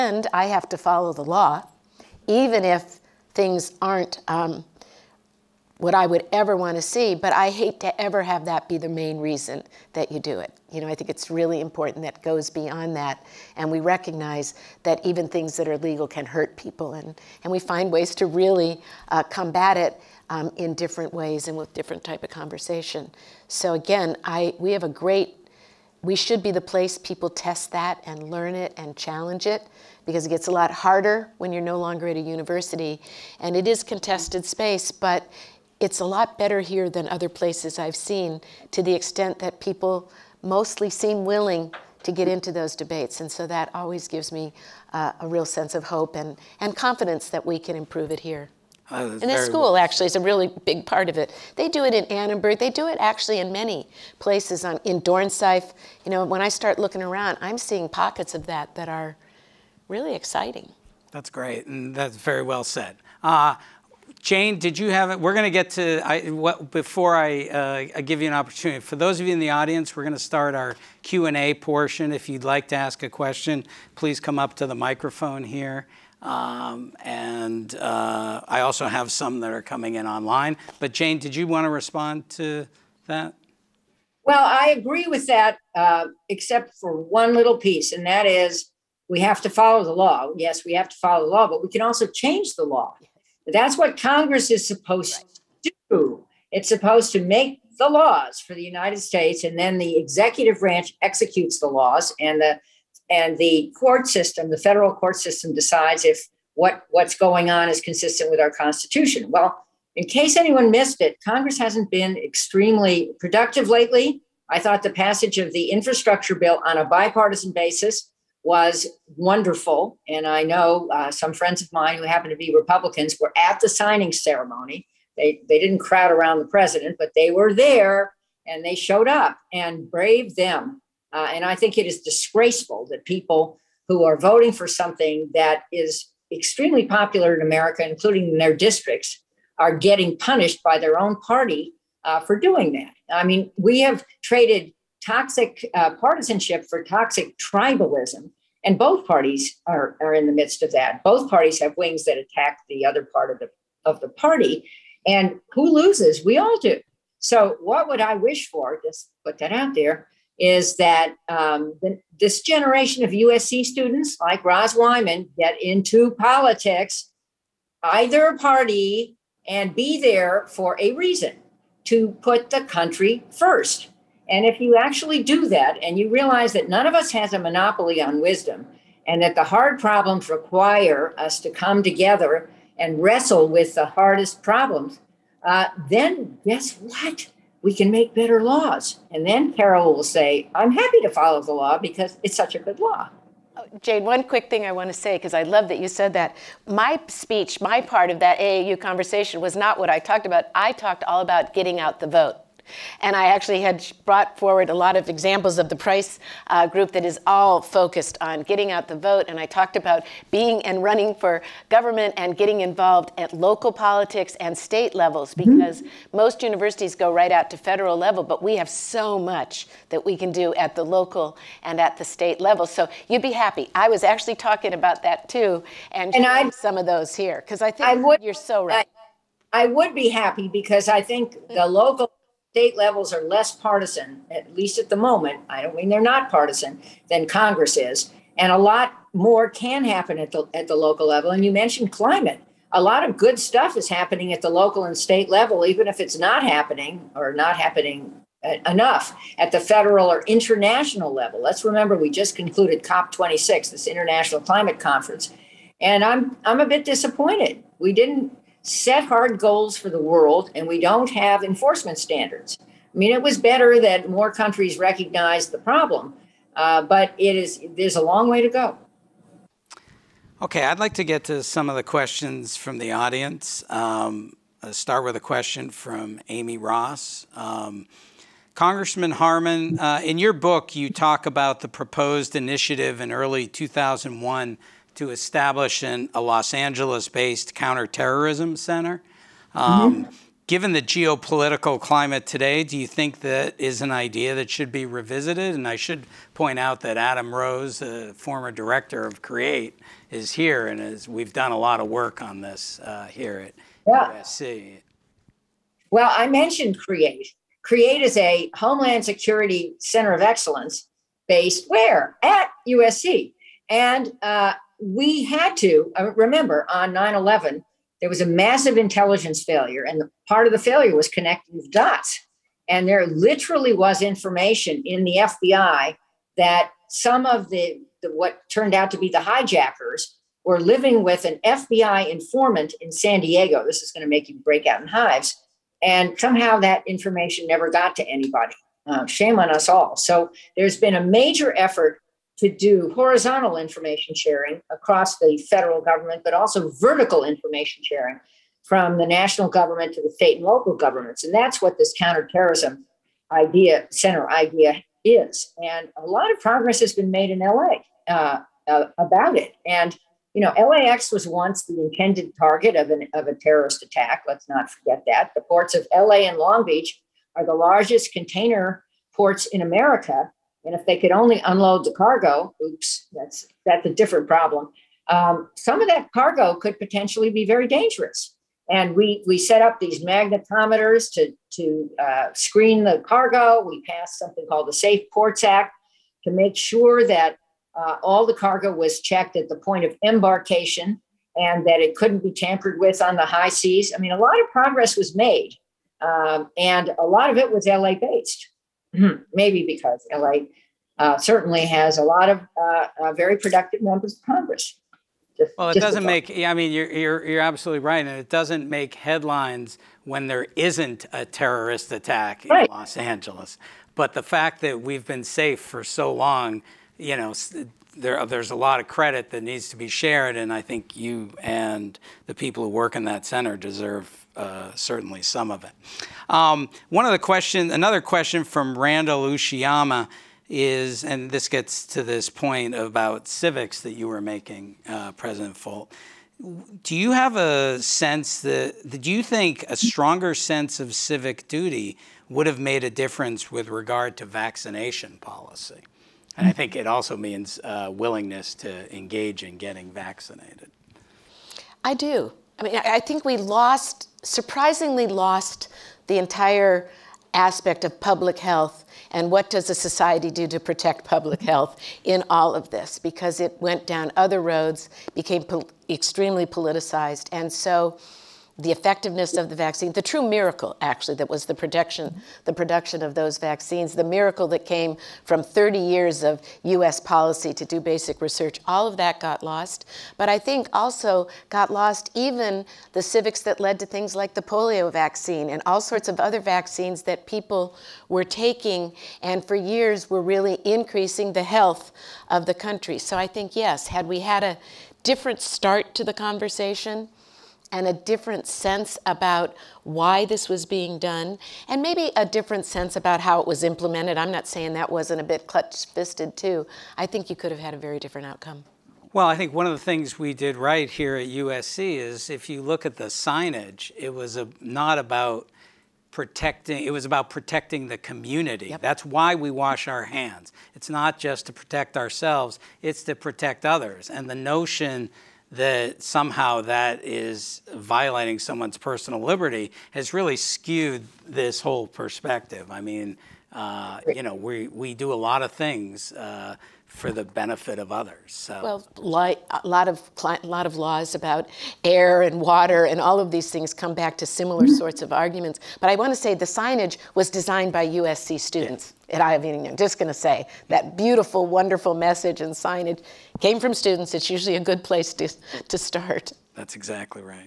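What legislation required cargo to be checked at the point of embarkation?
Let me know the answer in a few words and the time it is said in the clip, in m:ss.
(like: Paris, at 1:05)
Safe Ports Act, at 6:24.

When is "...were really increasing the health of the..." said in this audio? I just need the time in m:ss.
8:10.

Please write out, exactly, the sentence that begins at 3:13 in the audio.
Oh, Jane, one quick thing I want to say, because I love that you said that.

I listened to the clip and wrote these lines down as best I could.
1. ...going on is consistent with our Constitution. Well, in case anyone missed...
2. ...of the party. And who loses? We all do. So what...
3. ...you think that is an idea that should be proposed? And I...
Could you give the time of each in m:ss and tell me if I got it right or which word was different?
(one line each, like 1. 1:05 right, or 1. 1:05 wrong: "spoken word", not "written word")
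1. 1:47 right
2. 2:33 right
3. 4:52 wrong: "revisited", not "proposed".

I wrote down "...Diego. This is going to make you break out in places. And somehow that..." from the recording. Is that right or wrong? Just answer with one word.
wrong.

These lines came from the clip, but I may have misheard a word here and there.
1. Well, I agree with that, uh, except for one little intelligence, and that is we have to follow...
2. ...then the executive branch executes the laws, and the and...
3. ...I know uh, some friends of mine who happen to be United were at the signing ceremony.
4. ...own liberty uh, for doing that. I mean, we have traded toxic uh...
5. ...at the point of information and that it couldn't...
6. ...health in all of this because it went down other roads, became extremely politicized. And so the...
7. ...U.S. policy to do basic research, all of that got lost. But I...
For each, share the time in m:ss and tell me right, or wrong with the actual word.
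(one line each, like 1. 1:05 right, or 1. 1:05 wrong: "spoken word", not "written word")
1. 1:24 wrong: "piece", not "intelligence"
2. 1:39 right
3. 2:00 wrong: "Republicans", not "United"
4. 2:20 wrong: "party", not "liberty"
5. 6:29 wrong: "embarkation", not "information"
6. 7:41 right
7. 7:56 right.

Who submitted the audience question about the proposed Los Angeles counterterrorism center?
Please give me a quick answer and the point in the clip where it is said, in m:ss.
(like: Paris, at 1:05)
Amy Ross, at 4:36.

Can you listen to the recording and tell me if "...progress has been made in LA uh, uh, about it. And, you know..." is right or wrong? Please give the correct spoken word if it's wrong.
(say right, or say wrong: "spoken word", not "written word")
right.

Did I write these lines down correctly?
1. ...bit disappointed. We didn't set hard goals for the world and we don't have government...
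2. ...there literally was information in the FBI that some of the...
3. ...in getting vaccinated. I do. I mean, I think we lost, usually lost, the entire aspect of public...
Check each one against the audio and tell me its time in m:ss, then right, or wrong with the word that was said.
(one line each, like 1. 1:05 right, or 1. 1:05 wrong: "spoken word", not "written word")
1. 4:16 wrong: "enforcement", not "government"
2. 5:22 right
3. 7:29 wrong: "surprisingly", not "usually".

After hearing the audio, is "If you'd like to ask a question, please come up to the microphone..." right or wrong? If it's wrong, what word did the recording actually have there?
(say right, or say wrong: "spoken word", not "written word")
right.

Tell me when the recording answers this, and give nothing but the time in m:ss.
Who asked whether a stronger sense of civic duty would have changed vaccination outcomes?
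7:08.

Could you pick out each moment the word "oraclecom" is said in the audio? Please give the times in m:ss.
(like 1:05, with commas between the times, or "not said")
not said.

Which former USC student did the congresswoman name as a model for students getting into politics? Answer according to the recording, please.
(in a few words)
Roz Wyman.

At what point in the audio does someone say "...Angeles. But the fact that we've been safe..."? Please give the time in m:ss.
6:52.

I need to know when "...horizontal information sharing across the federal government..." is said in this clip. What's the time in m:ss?
5:42.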